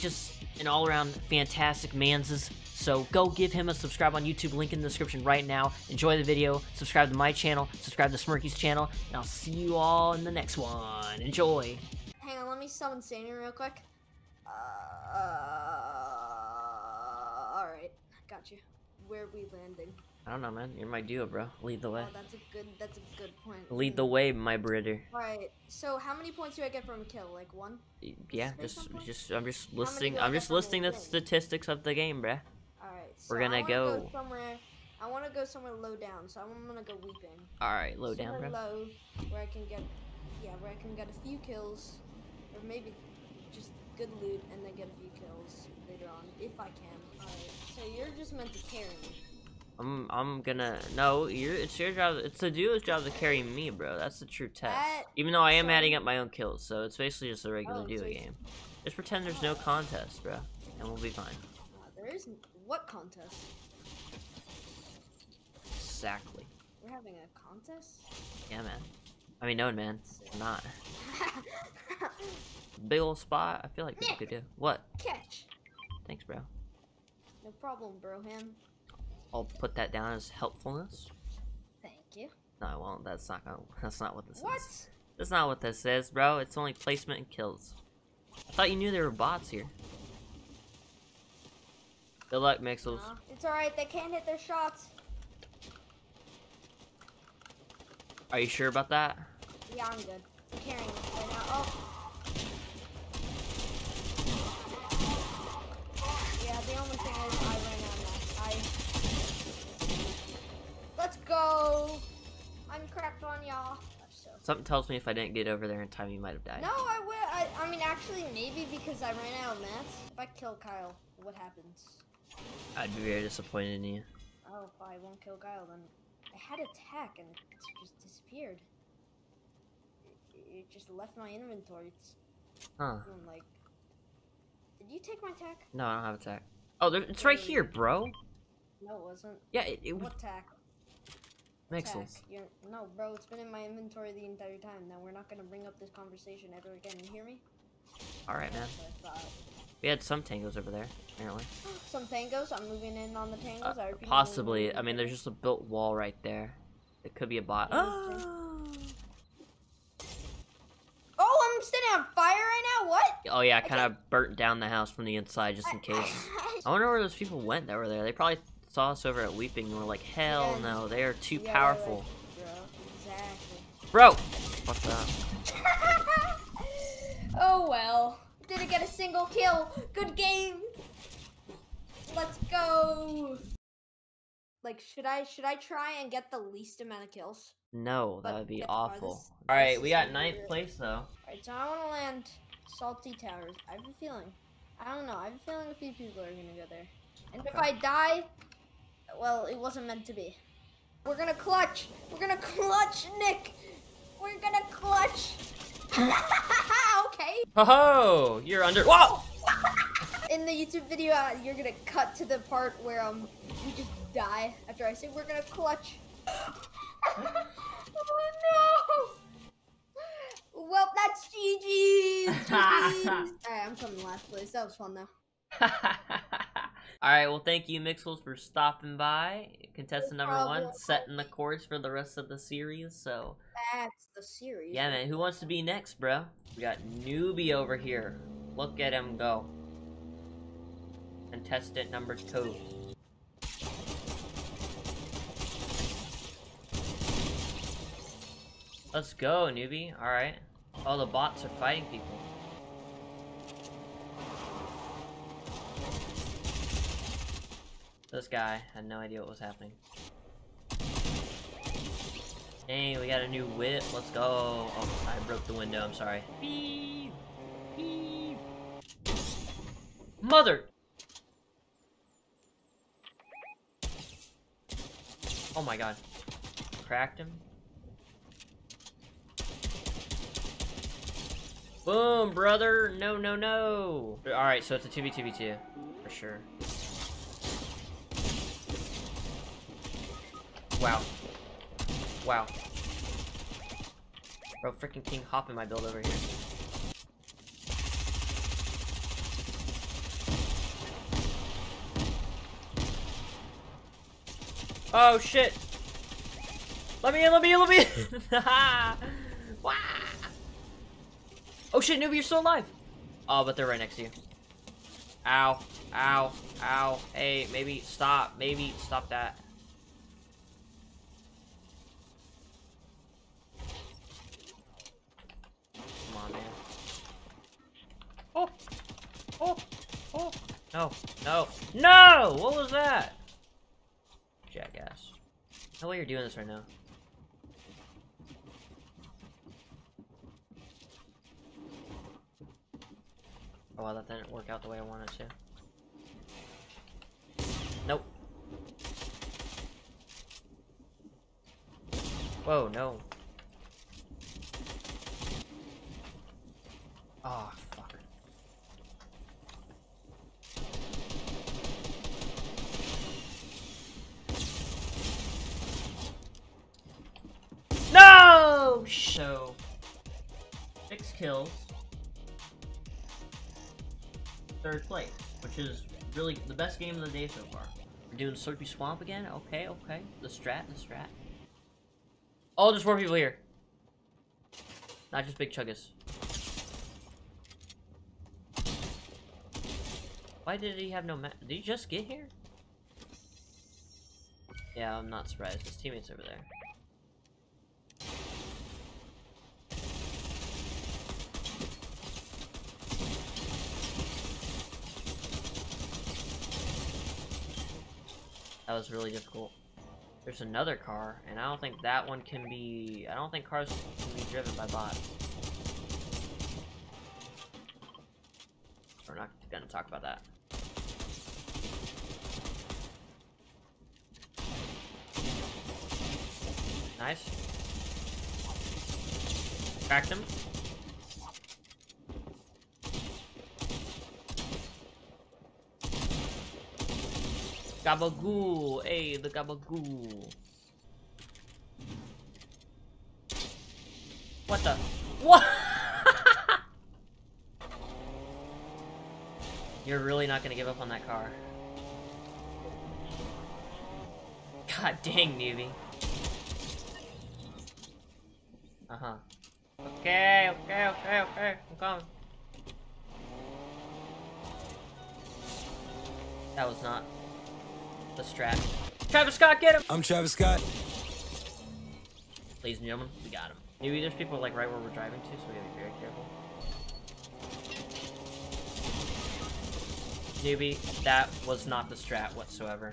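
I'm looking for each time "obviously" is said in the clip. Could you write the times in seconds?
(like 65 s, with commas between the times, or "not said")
not said.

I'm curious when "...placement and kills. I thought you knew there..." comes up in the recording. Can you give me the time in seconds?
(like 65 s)
86 s.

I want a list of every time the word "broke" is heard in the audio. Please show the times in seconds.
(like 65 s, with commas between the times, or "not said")
265 s.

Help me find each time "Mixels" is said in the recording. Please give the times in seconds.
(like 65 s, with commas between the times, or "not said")
92 s, 227 s.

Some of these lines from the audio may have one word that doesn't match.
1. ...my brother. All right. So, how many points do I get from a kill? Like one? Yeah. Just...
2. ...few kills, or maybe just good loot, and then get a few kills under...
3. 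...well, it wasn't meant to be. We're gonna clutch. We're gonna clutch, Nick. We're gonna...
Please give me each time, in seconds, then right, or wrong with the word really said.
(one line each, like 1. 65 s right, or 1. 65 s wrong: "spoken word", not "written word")
1. 24 s right
2. 41 s wrong: "later", not "under"
3. 199 s right.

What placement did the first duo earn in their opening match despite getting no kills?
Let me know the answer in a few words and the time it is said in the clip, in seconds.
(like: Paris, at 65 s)
9th place, at 190 s.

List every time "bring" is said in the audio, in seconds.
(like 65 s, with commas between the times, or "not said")
145 s.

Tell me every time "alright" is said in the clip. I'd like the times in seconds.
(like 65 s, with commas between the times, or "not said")
93 s, 222 s, 284 s.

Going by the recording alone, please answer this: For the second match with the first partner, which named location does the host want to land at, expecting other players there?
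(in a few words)
Salty Towers.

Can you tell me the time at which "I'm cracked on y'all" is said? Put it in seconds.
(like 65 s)
112 s.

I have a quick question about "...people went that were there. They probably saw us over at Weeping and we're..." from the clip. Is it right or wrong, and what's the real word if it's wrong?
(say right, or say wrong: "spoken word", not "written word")
right.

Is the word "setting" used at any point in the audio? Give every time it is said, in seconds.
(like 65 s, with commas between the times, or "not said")
230 s.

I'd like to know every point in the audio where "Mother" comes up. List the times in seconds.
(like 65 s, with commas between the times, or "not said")
270 s.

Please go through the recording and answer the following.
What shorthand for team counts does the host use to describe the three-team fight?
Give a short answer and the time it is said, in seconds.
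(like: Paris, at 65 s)
2v2v2, at 284 s.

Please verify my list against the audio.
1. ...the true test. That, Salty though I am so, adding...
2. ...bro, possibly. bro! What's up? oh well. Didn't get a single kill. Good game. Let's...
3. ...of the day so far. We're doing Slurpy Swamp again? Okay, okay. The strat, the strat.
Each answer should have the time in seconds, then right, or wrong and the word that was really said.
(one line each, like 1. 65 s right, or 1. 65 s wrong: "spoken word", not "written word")
1. 54 s wrong: "Even", not "Salty"
2. 173 s wrong: "exactly", not "possibly"
3. 376 s right.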